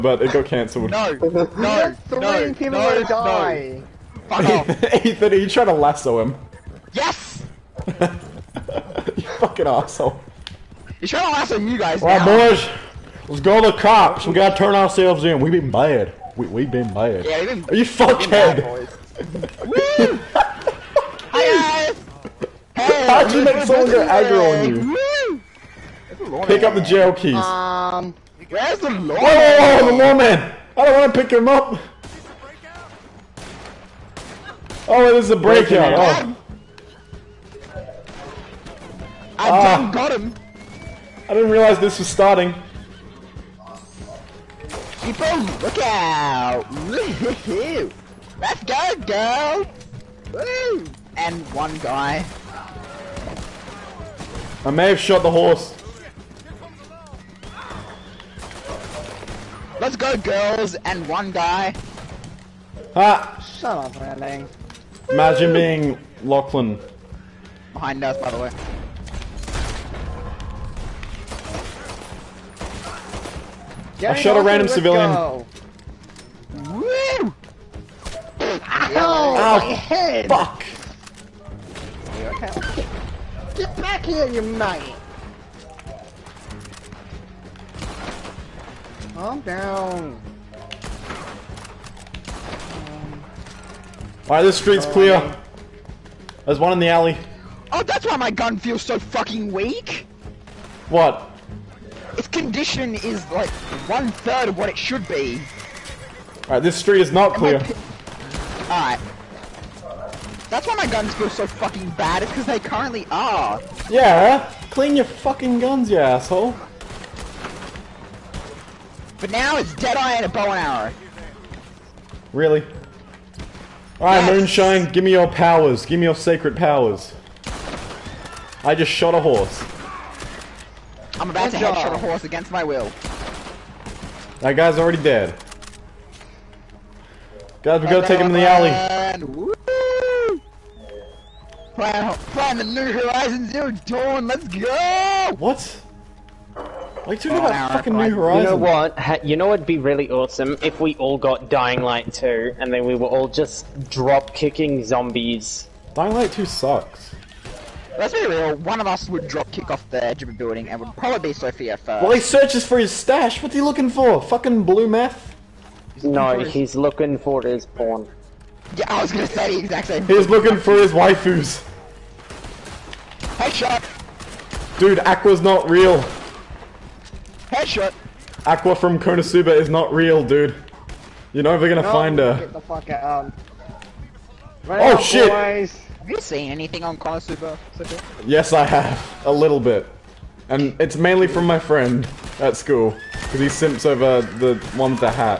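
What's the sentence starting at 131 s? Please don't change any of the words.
headshot a horse against my will.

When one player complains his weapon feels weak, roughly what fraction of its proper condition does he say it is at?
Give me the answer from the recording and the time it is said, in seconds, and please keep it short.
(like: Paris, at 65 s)
one third, at 103 s.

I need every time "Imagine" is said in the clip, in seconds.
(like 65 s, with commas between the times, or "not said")
65 s.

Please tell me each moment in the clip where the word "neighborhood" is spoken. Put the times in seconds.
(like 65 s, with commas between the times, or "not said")
not said.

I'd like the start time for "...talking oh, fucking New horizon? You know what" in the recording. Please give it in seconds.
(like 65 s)
147 s.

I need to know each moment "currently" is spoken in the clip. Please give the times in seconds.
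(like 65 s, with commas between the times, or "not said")
112 s.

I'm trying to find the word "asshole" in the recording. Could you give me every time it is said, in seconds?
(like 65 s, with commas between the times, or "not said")
9 s, 115 s.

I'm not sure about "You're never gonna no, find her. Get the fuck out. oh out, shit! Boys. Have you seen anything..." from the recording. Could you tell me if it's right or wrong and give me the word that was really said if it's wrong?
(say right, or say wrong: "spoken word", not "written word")
right.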